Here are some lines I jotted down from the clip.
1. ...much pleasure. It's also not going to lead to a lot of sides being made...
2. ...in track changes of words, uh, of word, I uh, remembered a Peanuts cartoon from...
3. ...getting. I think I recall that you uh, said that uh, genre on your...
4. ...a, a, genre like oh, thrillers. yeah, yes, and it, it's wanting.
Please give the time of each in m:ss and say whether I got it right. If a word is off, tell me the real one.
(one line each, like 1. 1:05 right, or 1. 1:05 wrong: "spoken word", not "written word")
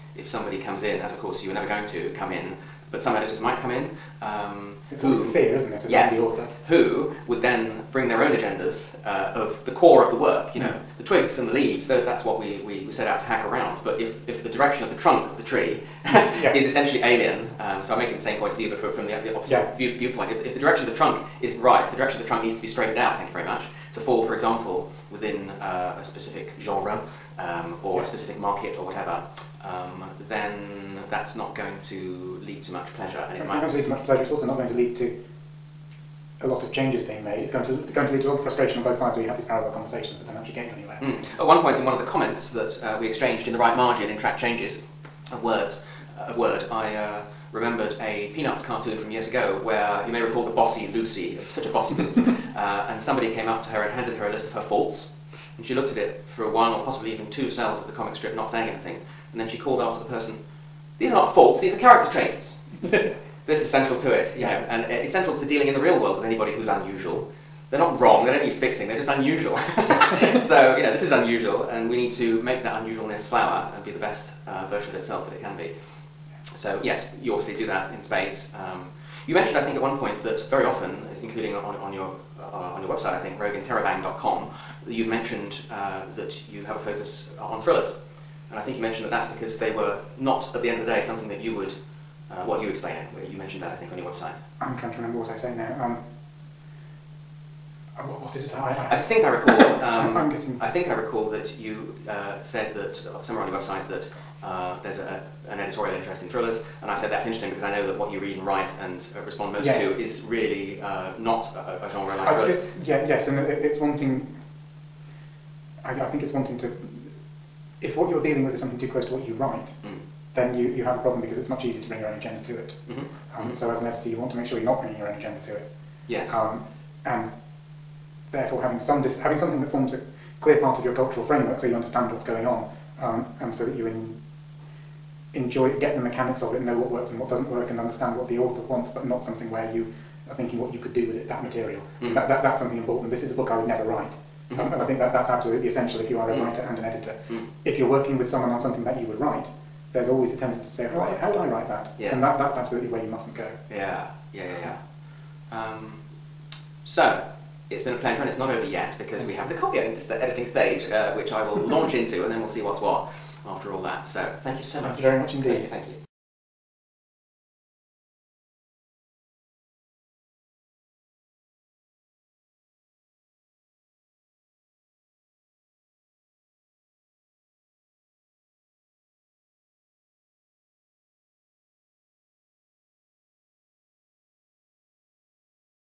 1. 0:33 wrong: "changes", not "sides"
2. 0:44 right
3. 1:40 wrong: "somewhere", not "genre"
4. 1:51 right.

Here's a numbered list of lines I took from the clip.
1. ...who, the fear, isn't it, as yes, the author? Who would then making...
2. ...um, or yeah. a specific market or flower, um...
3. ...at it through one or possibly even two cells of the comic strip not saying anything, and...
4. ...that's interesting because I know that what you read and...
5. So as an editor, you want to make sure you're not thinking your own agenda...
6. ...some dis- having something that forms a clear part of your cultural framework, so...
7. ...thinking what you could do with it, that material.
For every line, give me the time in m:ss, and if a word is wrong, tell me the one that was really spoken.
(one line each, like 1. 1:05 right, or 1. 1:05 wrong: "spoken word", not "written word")
1. 0:05 wrong: "bring", not "making"
2. 0:27 wrong: "whatever", not "flower"
3. 0:55 right
4. 1:47 right
5. 2:03 wrong: "bringing", not "thinking"
6. 2:08 right
7. 2:20 right.